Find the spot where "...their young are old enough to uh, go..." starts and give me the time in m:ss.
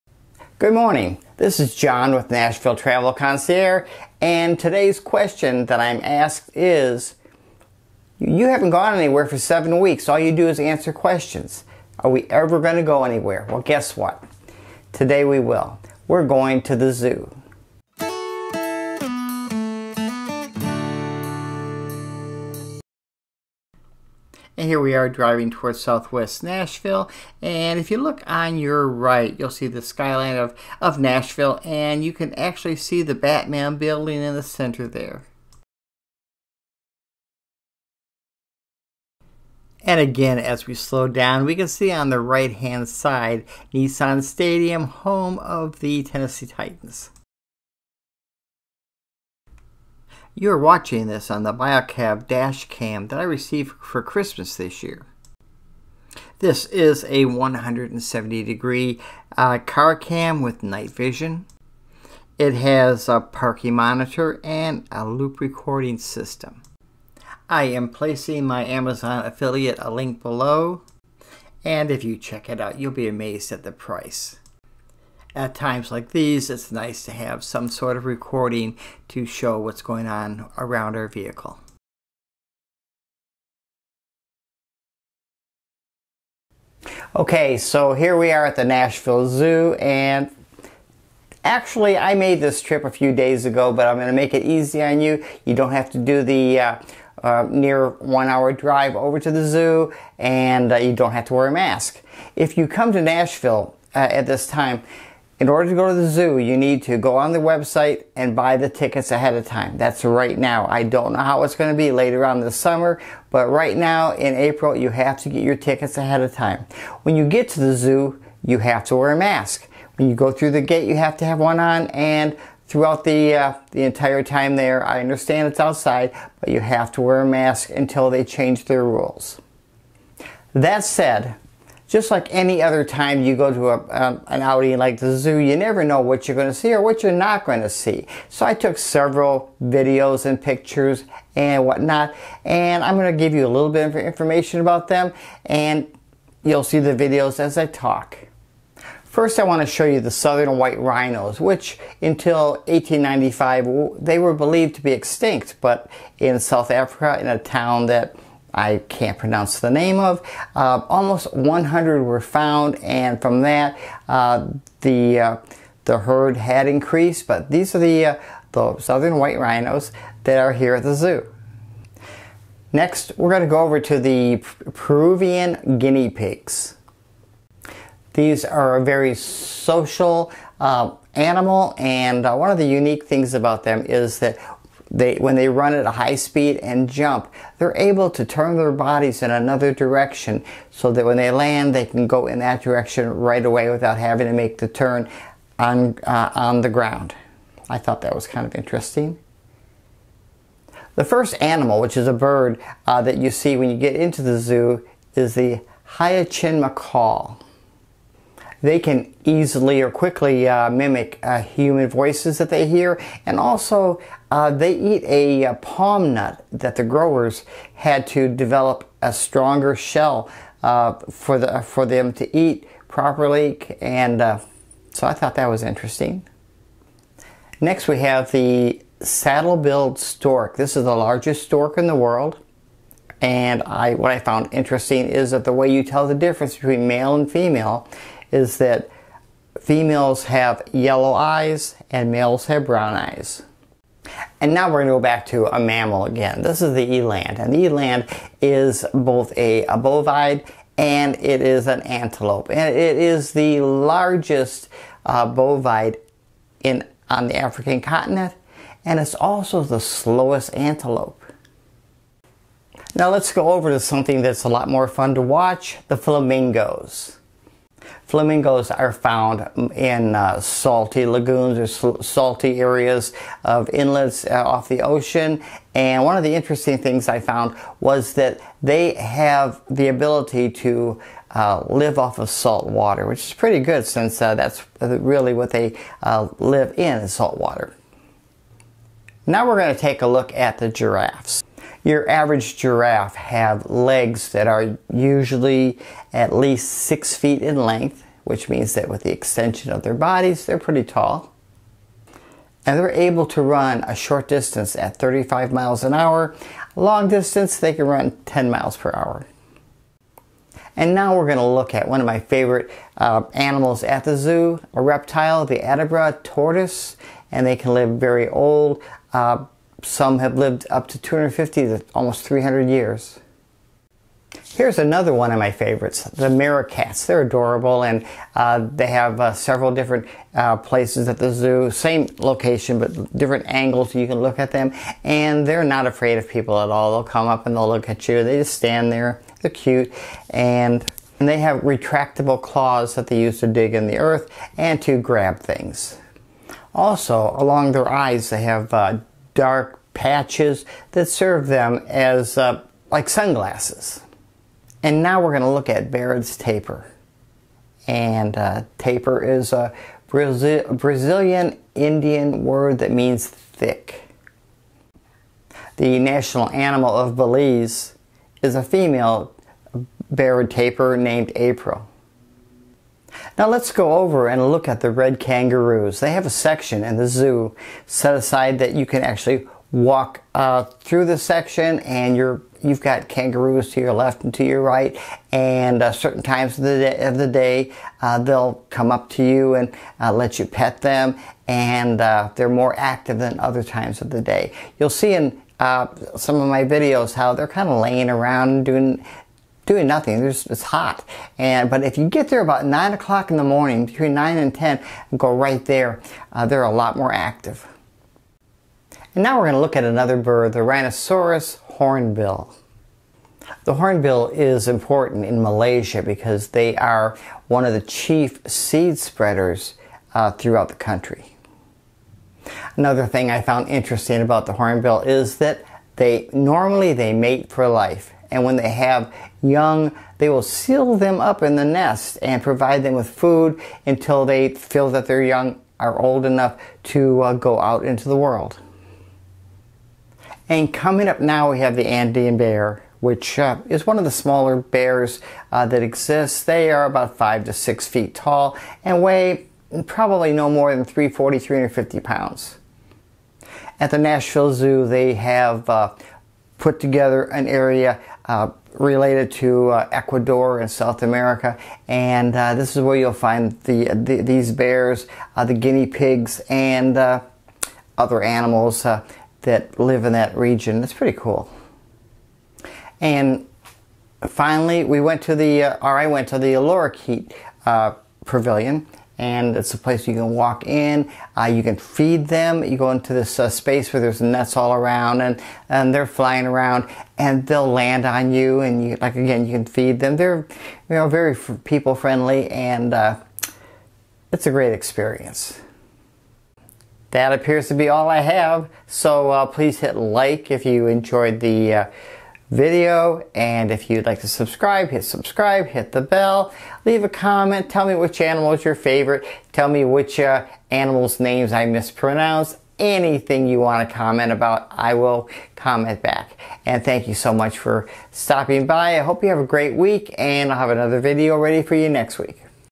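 7:15.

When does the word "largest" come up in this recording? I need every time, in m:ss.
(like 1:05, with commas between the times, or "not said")
3:50, 4:13.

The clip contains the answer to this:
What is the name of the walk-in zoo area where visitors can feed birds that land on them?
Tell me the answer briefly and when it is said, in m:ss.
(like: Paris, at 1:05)
Lorikeet Pavilion, at 7:56.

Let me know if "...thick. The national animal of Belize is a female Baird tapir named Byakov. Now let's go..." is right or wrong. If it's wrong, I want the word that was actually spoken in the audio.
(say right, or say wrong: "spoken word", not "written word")
wrong: "April", not "Byakov".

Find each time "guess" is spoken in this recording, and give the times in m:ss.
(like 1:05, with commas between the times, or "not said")
0:13.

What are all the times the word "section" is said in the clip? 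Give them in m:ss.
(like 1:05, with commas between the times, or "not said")
6:16, 6:21.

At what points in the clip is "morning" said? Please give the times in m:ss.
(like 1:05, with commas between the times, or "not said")
0:00, 6:43.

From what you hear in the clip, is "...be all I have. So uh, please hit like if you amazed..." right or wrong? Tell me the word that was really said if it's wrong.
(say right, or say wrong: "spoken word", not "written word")
wrong: "enjoyed", not "amazed".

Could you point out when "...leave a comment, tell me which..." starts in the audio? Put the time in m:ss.
8:26.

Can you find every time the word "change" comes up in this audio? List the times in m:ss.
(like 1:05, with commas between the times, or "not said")
2:08.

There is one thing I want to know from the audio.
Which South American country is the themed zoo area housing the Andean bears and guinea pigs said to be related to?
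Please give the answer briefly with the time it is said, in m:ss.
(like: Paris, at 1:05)
Ecuador, at 7:39.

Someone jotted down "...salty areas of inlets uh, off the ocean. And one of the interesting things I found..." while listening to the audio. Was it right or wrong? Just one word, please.
right.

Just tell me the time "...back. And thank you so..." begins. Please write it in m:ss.
8:36.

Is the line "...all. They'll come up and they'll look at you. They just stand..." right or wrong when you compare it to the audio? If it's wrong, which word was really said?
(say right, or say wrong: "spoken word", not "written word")
right.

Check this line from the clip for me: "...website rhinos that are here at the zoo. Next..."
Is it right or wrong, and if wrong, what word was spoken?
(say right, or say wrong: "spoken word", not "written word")
wrong: "white", not "website".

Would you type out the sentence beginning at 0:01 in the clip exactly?
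This is John with Nashville Travel Concierge, and today's question that I'm asked is You haven't gone anywhere for seven weeks.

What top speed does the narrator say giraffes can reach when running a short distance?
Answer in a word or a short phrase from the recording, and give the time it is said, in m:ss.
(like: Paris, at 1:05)
35 miles an hour, at 5:04.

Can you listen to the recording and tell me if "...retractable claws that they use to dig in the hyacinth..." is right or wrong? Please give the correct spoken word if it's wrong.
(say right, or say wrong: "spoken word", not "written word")
wrong: "earth", not "hyacinth".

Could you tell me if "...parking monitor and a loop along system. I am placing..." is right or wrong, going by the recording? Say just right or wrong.
wrong.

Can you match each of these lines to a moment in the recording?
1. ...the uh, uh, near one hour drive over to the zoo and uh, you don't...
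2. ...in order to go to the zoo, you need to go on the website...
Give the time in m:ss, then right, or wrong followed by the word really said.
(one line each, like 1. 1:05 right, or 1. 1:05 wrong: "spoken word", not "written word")
1. 1:36 right
2. 1:45 right.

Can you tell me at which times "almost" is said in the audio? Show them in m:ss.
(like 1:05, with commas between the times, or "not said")
2:40, 5:21.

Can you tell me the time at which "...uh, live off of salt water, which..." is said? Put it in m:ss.
4:41.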